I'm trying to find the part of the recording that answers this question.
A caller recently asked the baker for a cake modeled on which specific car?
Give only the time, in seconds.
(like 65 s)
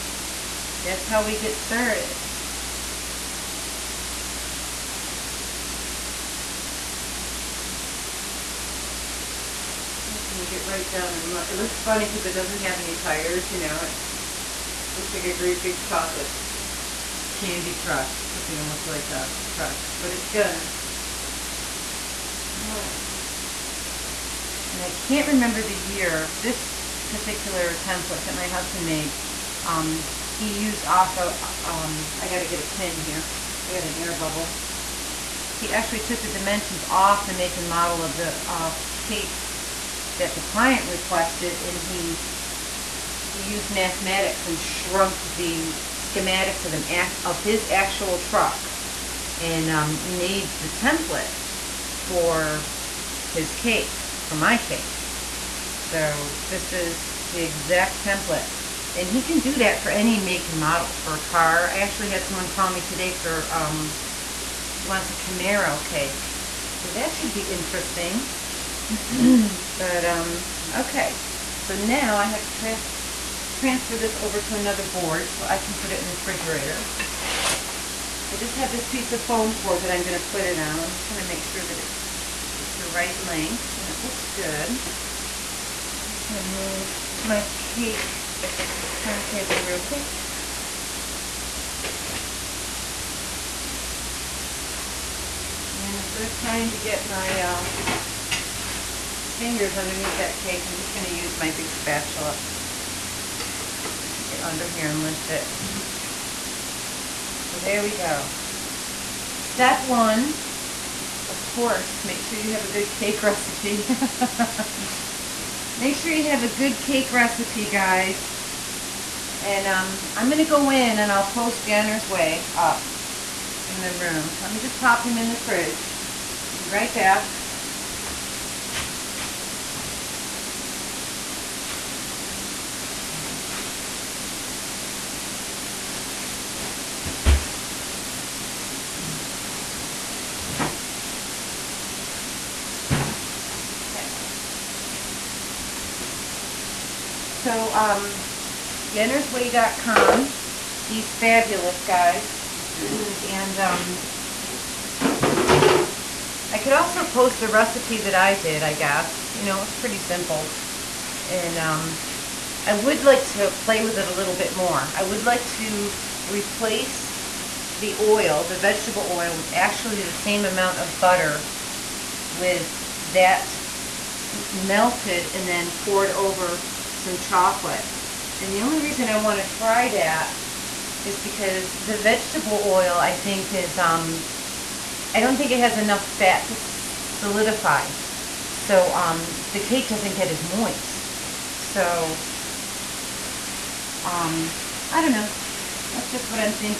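65 s.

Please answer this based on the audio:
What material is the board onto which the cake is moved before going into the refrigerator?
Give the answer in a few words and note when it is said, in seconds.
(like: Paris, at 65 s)
foam core, at 79 s.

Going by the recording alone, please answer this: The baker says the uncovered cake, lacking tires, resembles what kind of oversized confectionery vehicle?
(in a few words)
chocolate candy truck.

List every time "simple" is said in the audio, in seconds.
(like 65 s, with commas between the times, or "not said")
159 s.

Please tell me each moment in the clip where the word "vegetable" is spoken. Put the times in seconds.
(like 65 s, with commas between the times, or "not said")
168 s, 181 s.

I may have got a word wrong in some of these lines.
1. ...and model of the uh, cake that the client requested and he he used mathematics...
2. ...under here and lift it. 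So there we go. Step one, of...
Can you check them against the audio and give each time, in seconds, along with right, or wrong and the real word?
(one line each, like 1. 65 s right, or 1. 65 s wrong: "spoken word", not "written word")
1. 37 s right
2. 104 s right.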